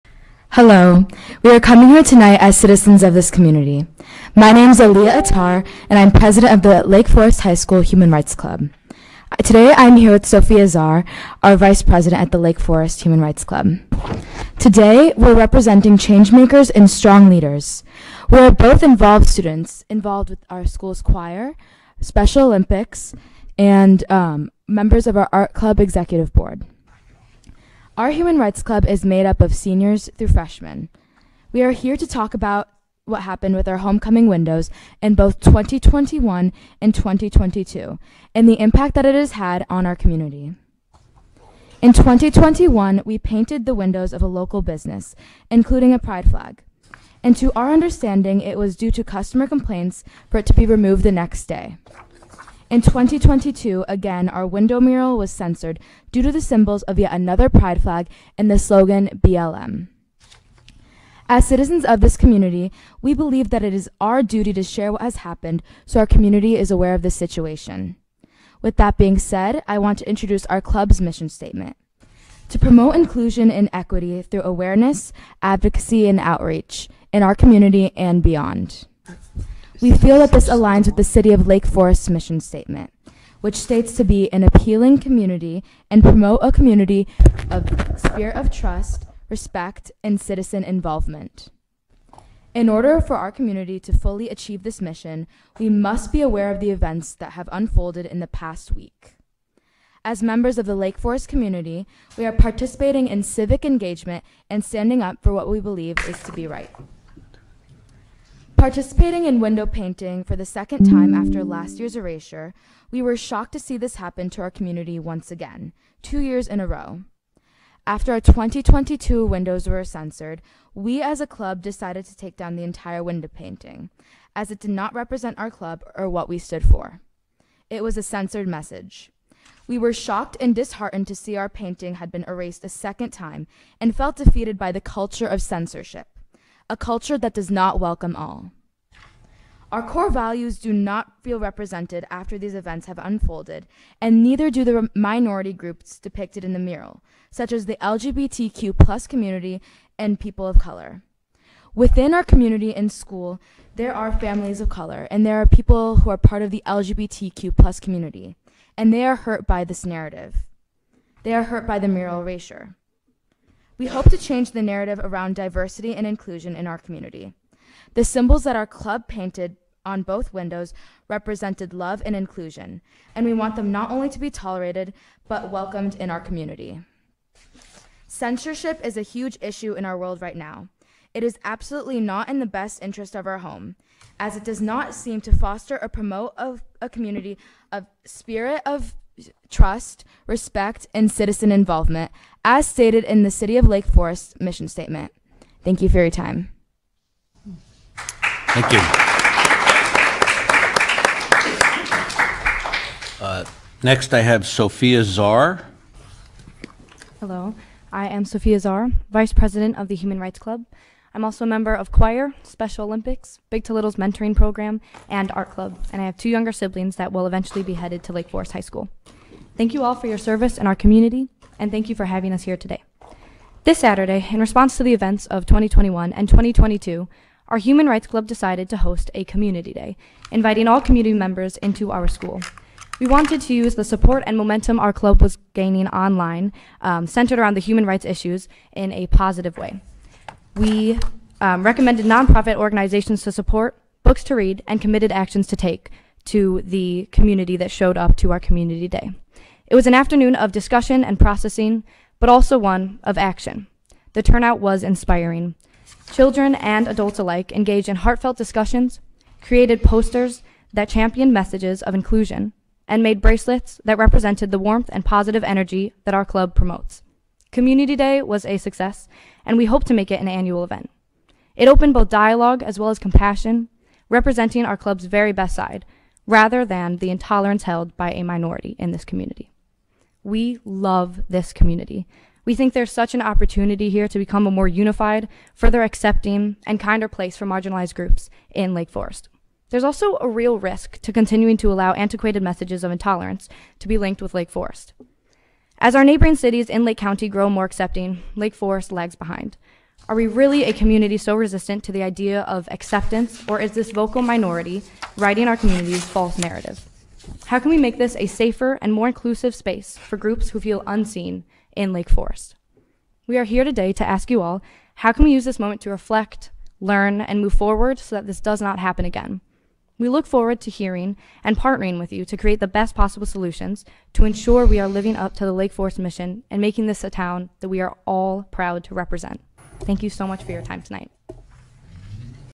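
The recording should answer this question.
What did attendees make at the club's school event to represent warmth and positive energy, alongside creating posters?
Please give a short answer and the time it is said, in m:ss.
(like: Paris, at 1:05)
Bracelets, at 4:23.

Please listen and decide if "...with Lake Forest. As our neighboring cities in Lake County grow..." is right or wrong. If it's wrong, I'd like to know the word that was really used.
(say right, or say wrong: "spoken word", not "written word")
right.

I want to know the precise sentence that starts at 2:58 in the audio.
Censorship is a huge issue in our world right now.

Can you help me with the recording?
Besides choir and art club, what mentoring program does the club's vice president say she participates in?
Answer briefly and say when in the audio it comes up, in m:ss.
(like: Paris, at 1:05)
Big to Little's, at 3:33.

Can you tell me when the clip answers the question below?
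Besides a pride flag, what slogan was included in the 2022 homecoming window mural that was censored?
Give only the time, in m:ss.
0:59.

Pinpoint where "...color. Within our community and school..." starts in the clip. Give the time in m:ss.
2:30.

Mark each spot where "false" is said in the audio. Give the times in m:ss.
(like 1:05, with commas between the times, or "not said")
5:06.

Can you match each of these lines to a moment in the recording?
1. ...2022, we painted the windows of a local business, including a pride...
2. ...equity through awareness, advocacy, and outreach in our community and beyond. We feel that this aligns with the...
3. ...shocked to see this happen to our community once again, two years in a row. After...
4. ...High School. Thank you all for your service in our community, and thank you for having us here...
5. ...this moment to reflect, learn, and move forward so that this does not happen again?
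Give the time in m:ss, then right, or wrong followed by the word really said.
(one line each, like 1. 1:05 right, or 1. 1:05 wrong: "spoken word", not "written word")
1. 0:41 wrong: "2021", not "2022"
2. 1:13 right
3. 1:53 right
4. 3:38 right
5. 5:15 right.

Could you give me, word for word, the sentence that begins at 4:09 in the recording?
It was an afternoon of discussion and processing, but also one of action.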